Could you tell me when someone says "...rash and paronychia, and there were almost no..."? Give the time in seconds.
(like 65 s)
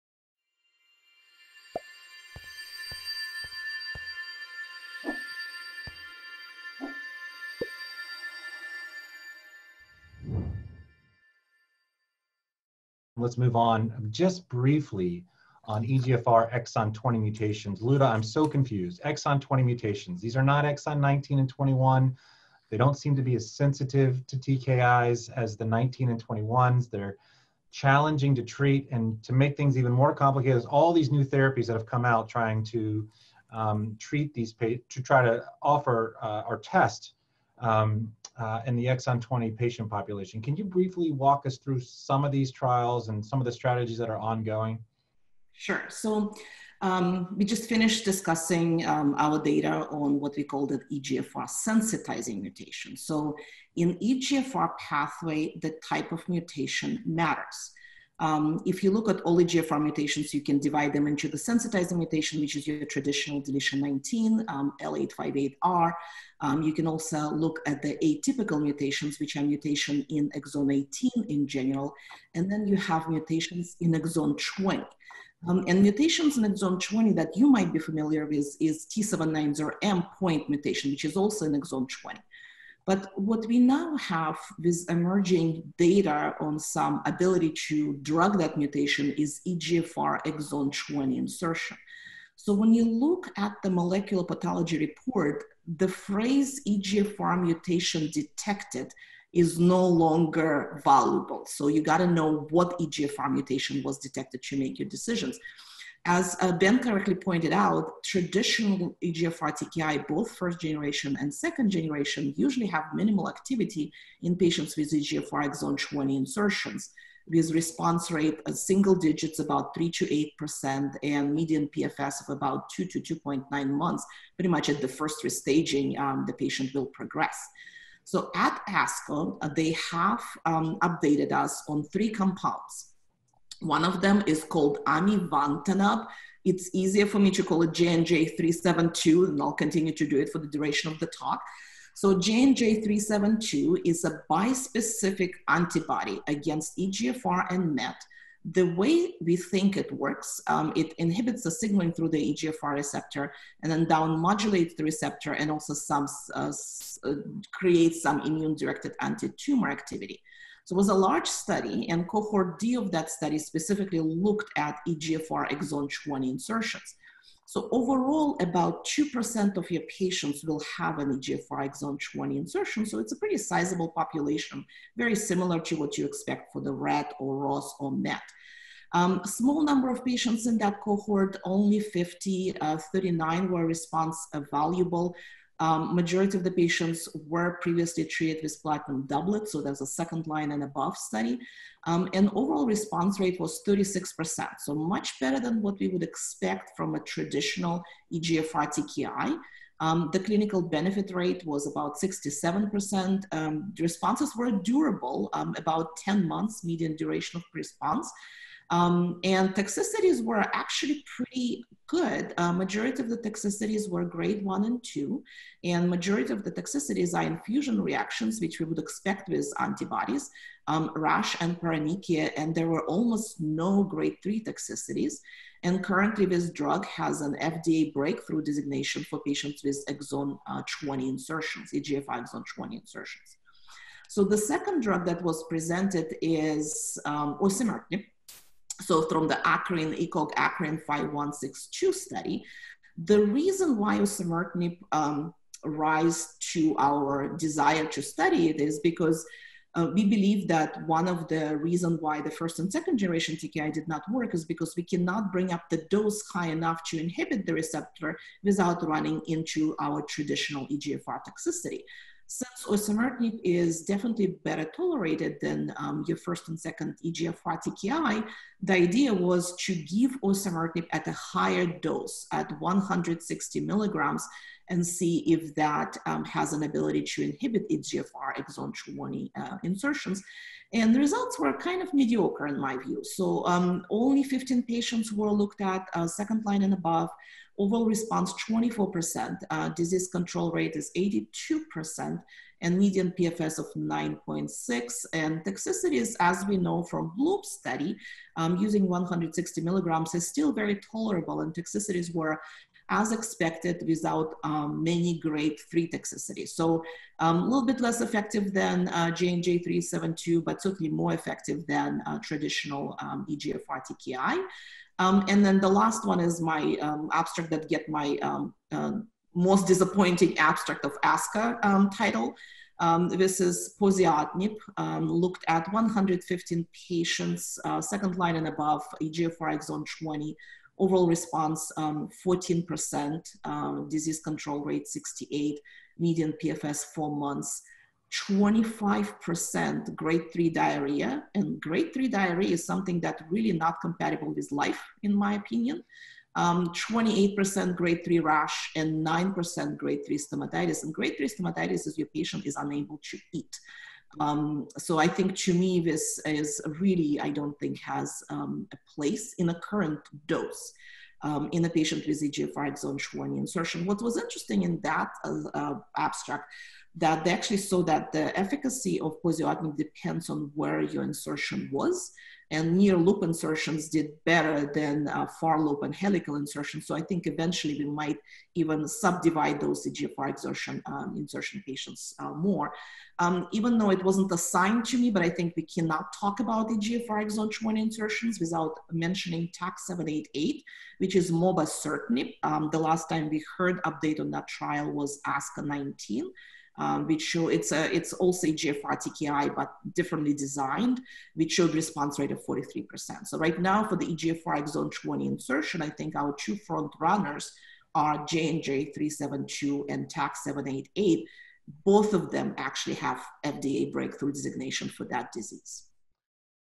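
220 s.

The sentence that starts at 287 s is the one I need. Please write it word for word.
Overall response 24%, uh, disease control rate is 82%, and median PFS of 9.6.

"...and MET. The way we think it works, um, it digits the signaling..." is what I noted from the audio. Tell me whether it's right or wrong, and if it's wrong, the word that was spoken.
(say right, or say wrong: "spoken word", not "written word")
wrong: "inhibits", not "digits".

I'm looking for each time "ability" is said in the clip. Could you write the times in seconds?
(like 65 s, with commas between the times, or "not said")
87 s, 276 s.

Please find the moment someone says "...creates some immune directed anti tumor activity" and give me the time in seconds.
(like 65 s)
157 s.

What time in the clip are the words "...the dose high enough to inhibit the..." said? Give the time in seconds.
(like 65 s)
255 s.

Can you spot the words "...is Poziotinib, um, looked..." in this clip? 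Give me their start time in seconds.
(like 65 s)
323 s.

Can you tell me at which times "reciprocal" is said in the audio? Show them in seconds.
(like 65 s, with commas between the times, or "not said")
not said.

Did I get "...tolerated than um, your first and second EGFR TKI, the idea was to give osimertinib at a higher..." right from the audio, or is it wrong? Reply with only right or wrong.
right.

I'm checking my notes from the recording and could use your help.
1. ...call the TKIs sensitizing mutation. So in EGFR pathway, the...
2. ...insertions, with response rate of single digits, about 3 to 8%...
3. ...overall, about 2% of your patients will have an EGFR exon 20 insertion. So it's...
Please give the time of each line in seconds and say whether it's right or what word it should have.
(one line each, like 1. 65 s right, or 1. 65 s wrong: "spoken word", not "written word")
1. 50 s wrong: "EGFR", not "TKIs"
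2. 116 s right
3. 167 s right.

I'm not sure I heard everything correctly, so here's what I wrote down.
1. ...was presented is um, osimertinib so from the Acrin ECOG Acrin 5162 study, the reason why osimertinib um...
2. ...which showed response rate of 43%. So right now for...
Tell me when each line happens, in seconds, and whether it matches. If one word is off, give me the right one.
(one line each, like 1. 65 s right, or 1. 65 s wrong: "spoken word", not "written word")
1. 235 s right
2. 401 s right.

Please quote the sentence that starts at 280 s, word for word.
And the results were kind of mediocre in my view.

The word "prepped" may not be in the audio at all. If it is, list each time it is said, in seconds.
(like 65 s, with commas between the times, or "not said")
not said.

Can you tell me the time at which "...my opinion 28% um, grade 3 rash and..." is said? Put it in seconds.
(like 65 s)
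345 s.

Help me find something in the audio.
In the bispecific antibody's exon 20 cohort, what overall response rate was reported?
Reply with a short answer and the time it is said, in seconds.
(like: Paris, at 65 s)
36%, at 193 s.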